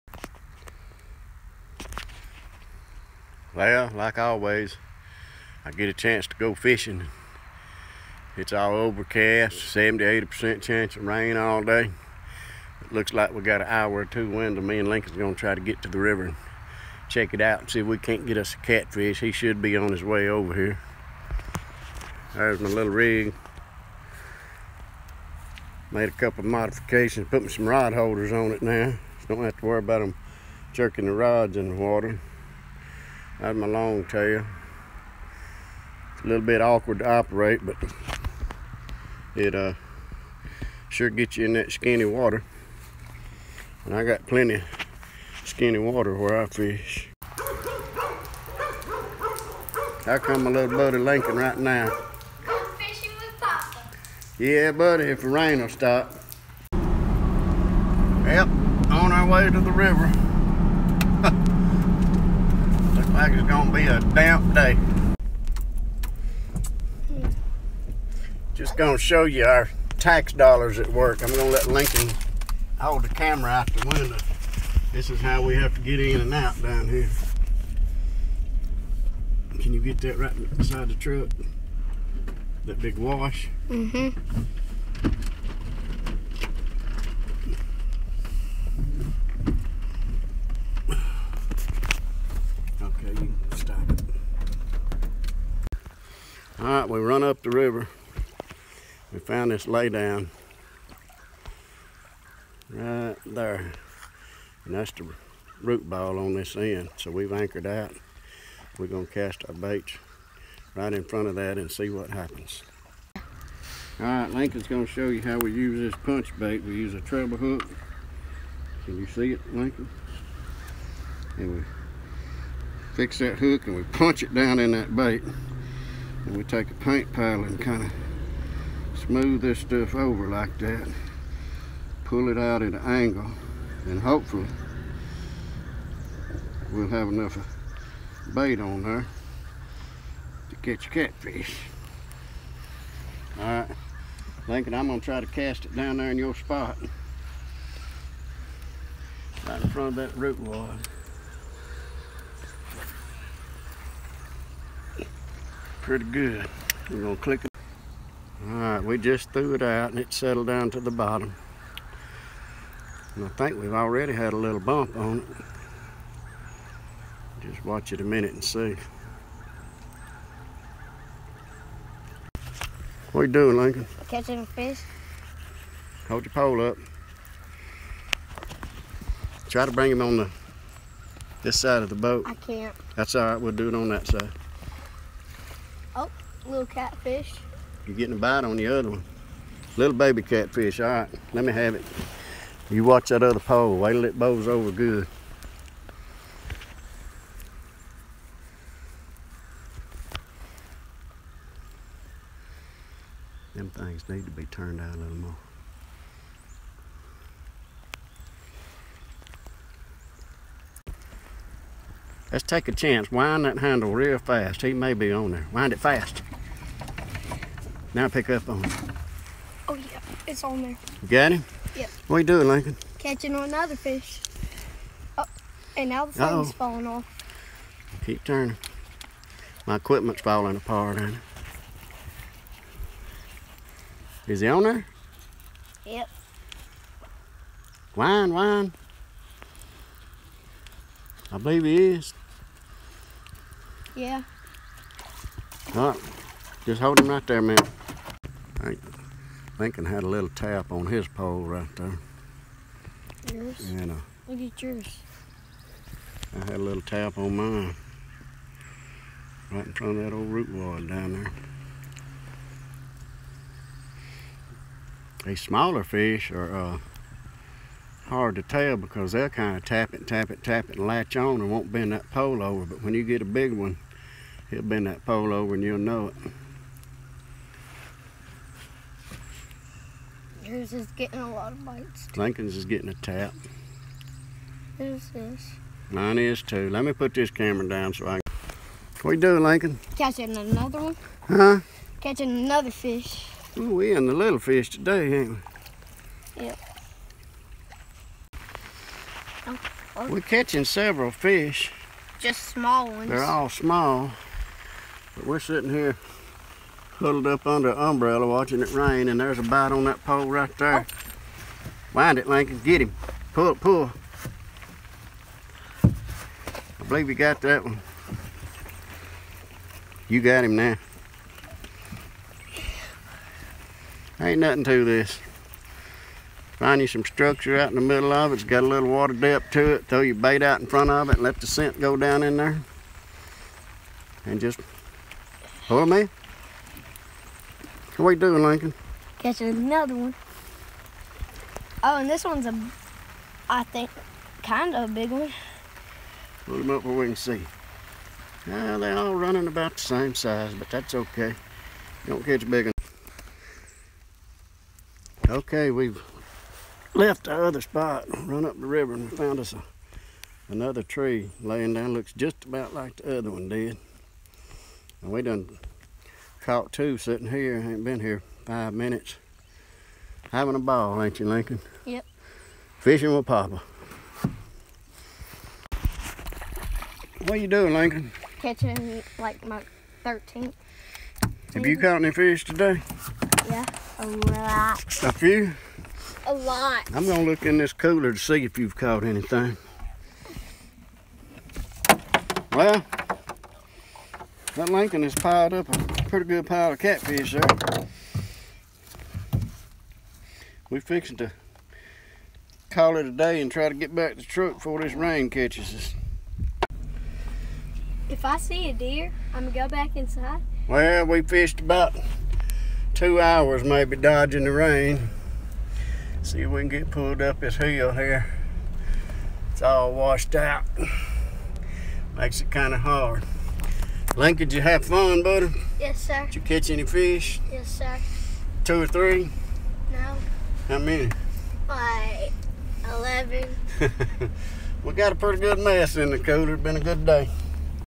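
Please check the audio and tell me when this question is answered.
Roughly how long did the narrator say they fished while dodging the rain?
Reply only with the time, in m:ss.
6:51.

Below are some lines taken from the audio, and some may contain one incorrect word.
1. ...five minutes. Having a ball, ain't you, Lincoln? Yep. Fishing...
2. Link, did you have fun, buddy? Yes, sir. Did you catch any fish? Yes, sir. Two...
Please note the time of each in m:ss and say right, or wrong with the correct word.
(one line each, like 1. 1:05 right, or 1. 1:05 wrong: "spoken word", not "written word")
1. 6:08 right
2. 7:04 right.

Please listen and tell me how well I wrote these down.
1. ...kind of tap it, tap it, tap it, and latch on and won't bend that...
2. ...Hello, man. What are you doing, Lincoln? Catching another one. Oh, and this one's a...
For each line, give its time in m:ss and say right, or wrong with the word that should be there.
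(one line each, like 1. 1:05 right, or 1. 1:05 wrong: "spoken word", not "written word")
1. 4:29 right
2. 5:35 right.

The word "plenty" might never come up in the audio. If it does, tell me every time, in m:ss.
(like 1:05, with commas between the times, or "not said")
0:44.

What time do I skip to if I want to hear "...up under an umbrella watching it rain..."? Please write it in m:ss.
5:07.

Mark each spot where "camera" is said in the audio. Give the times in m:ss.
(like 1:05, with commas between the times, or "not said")
1:13, 4:47.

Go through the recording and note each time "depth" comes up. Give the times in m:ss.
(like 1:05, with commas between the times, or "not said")
5:29.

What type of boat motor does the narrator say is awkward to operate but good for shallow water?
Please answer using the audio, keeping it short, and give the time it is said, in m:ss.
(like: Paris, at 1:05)
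long tail, at 0:33.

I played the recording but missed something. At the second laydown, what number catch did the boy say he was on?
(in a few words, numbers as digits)
13th.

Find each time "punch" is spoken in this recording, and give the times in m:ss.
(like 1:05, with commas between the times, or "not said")
1:56, 2:03.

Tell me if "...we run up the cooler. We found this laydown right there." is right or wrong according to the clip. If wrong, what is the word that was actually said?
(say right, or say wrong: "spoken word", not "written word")
wrong: "river", not "cooler".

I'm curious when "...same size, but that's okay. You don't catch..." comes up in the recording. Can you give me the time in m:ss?
5:49.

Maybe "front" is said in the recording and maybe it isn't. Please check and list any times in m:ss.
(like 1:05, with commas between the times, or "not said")
1:51, 2:29, 4:19, 5:30.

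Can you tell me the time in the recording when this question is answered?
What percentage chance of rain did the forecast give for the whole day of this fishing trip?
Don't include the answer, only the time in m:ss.
0:09.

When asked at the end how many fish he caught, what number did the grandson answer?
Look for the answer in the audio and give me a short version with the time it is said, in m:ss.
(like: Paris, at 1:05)
11, at 7:12.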